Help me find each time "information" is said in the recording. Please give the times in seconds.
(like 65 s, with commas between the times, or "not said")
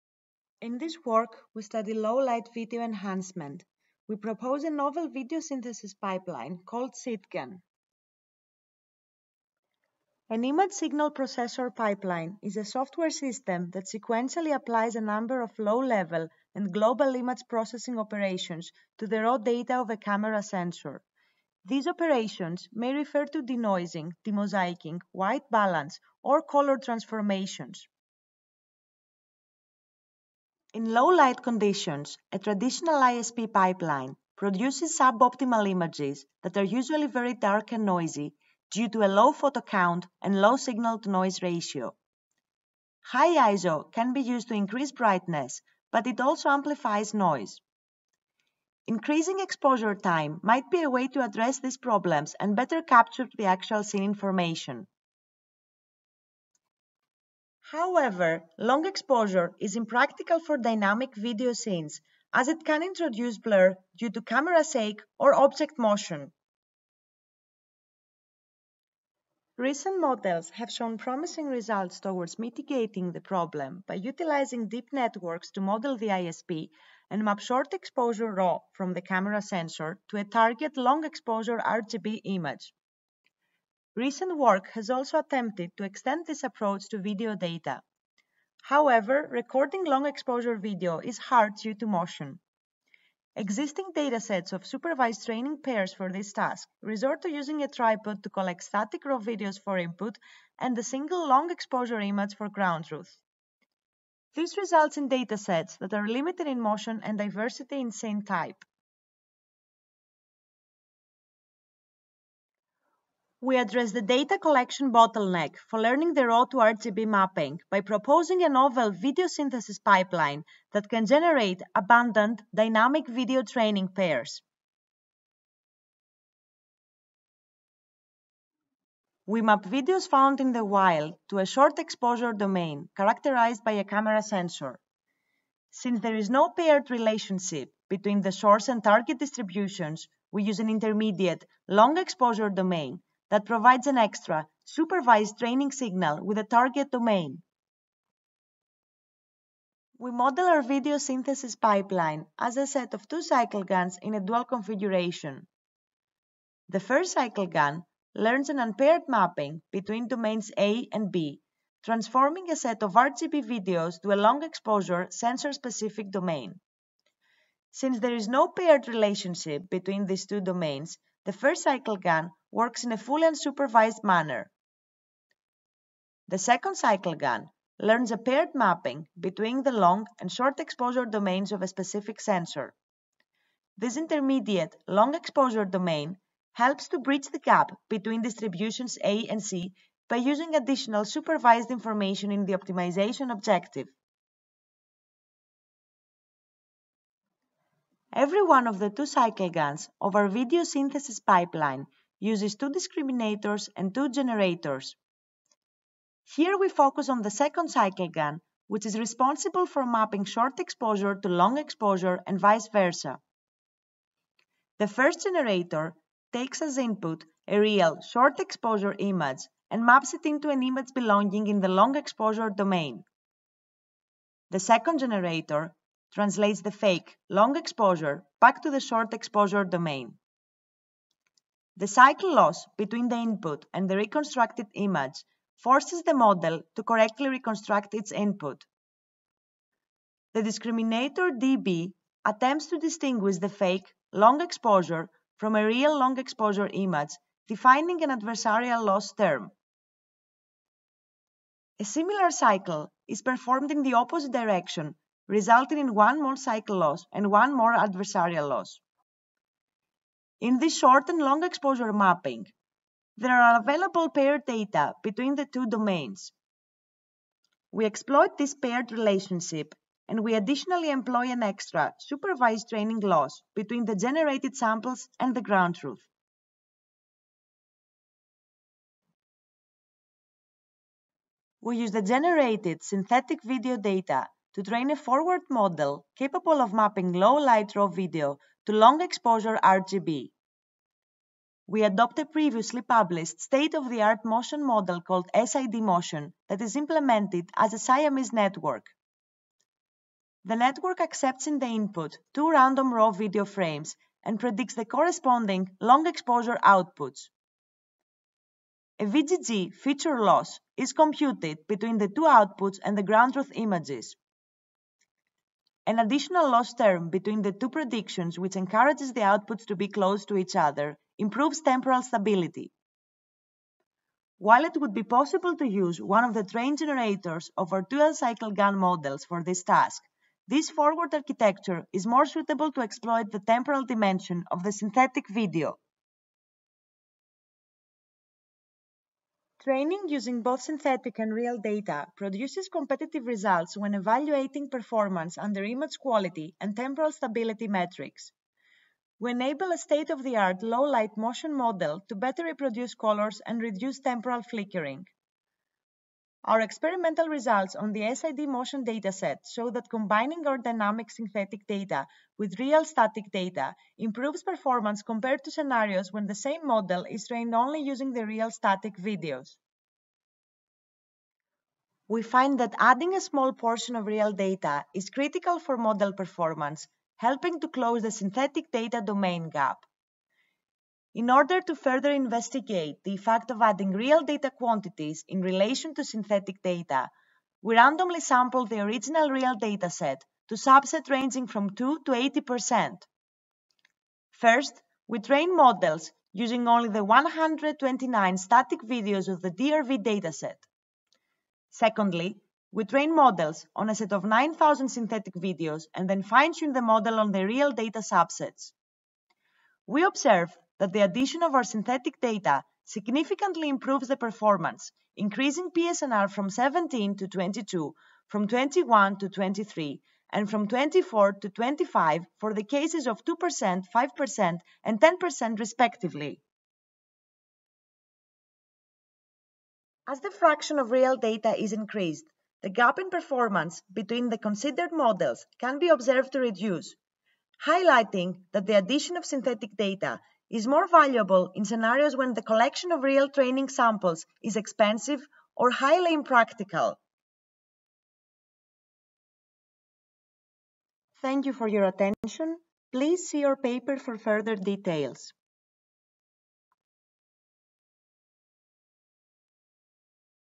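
54 s, 191 s.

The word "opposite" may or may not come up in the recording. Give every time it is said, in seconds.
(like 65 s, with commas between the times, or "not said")
253 s.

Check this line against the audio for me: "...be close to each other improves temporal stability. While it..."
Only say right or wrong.
right.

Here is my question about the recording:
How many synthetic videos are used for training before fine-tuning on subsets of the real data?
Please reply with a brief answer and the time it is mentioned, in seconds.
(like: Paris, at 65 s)
9,000, at 404 s.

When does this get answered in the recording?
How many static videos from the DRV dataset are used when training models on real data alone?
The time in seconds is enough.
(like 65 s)
397 s.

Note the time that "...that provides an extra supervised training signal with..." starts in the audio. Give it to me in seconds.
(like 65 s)
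143 s.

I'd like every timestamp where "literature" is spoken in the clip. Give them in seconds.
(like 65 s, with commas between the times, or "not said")
not said.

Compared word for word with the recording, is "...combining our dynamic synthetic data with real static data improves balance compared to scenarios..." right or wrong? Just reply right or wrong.
wrong.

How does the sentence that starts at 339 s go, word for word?
Training using both synthetic and real data produces competitive results when evaluating performance under image quality and temporal stability metrics.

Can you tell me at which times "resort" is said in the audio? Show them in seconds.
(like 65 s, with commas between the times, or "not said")
96 s.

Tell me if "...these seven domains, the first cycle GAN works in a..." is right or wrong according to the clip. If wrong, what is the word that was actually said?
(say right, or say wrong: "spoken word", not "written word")
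wrong: "two", not "seven".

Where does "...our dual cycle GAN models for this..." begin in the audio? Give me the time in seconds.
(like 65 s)
327 s.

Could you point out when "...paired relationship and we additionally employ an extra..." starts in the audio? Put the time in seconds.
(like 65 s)
268 s.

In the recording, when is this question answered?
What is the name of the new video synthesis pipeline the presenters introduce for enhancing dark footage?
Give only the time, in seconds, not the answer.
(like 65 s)
6 s.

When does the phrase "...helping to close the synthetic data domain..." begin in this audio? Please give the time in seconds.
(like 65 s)
377 s.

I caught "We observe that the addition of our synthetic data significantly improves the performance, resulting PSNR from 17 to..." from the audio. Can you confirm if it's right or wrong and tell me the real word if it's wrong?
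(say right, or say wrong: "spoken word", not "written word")
wrong: "increasing", not "resulting".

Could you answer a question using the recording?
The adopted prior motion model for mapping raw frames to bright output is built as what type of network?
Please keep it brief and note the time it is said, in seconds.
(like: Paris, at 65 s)
Siamese network, at 297 s.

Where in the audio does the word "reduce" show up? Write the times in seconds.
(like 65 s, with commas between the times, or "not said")
353 s, 436 s.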